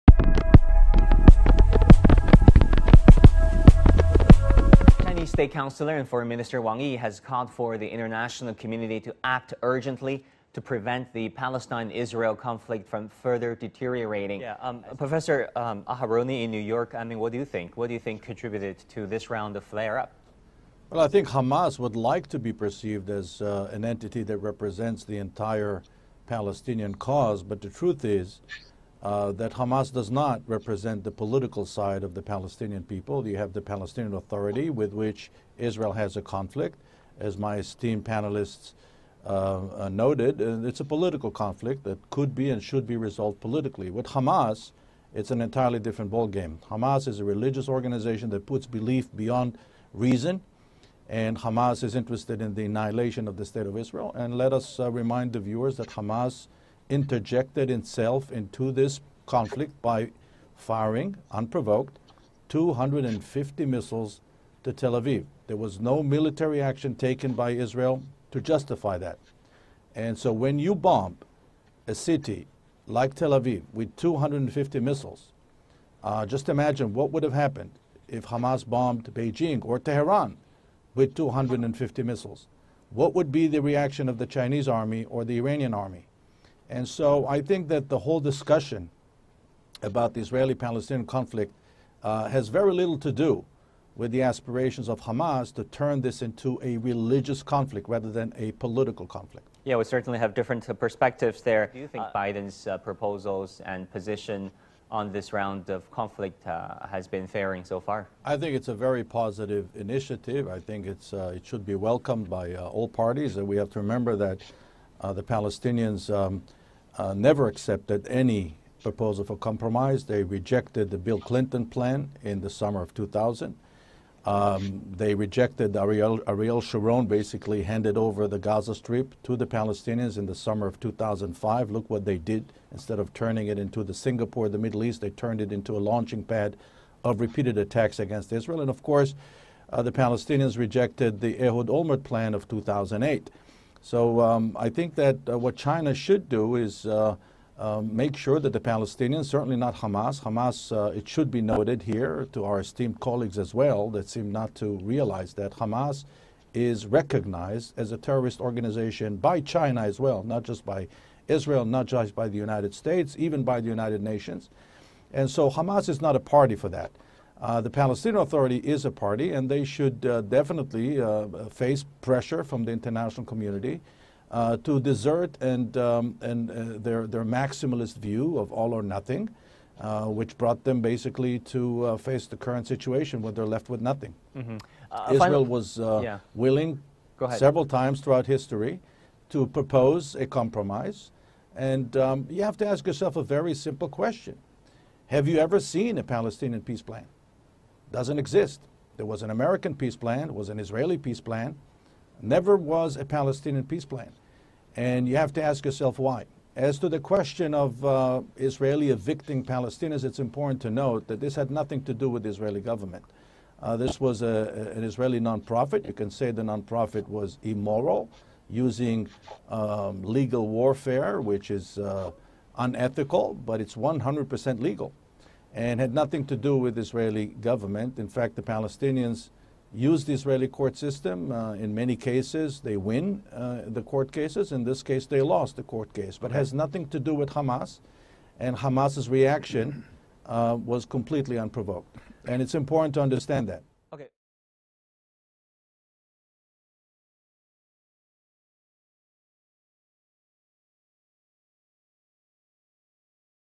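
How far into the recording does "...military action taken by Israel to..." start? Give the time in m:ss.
1:06.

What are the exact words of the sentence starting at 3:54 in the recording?
In this case, they lost the court case, but has nothing to do with Hamas.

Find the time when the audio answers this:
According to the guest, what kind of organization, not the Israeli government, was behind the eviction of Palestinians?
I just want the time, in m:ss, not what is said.
3:34.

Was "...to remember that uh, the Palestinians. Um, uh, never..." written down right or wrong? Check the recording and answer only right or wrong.
right.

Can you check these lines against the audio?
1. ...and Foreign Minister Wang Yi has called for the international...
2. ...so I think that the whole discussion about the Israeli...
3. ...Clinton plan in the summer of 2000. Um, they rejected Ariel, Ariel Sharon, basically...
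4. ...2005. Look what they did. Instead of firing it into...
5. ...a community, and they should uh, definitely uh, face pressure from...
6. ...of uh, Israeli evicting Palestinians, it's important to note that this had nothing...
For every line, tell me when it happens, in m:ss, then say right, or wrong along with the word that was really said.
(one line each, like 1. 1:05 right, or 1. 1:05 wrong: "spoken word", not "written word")
1. 0:05 right
2. 1:26 right
3. 2:01 right
4. 2:10 wrong: "turning", not "firing"
5. 2:48 wrong: "party", not "community"
6. 3:27 right.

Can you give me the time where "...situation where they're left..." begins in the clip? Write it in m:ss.
3:02.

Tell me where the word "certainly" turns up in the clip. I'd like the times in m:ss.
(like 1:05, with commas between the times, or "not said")
1:39, 2:29.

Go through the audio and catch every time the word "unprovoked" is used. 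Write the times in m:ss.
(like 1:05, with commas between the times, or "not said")
1:01, 4:01.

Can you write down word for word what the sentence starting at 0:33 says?
You have the Palestinian Authority, with which Israel has a conflict.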